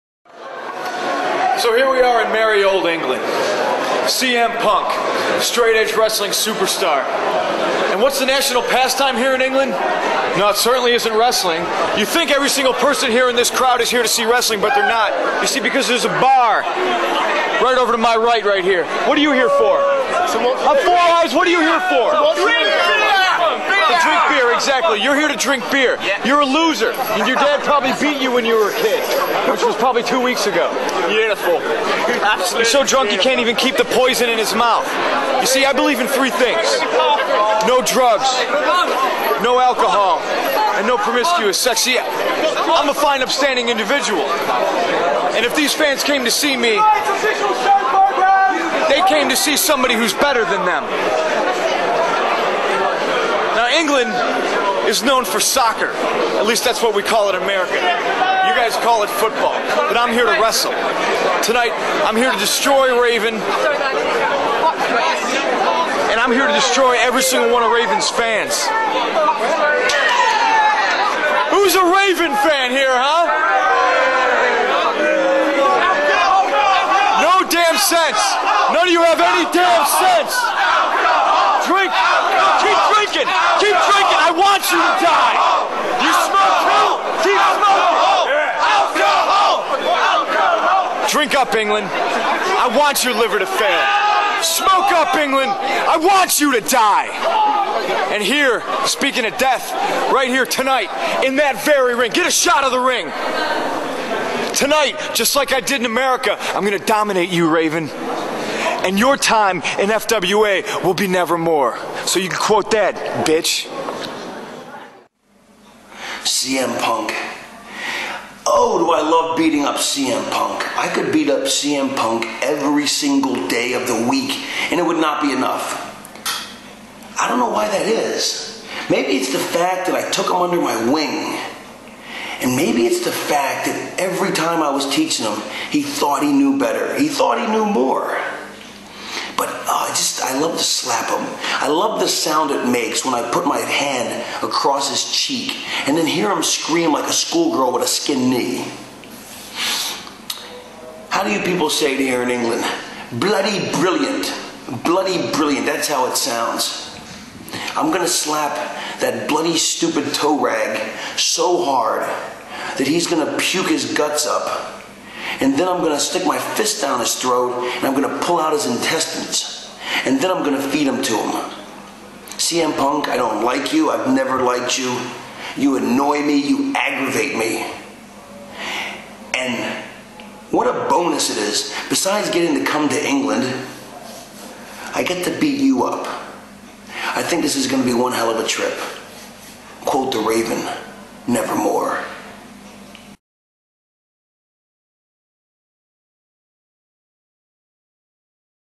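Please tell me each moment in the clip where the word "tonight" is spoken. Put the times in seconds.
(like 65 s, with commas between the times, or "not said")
61 s, 100 s, 104 s.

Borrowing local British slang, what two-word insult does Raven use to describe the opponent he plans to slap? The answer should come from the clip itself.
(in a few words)
toe rag.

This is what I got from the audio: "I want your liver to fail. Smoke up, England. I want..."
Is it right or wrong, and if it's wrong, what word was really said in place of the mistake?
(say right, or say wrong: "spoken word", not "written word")
right.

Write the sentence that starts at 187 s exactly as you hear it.
I think this is going to be one hell of a trip.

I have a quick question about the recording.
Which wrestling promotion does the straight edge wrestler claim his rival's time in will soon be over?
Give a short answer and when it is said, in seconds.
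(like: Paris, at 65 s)
FWA, at 109 s.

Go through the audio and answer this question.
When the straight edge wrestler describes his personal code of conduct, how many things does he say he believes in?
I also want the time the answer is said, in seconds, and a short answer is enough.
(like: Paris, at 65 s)
3, at 36 s.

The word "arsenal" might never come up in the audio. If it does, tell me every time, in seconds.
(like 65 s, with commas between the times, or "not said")
not said.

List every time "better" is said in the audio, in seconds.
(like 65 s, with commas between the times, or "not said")
50 s, 136 s.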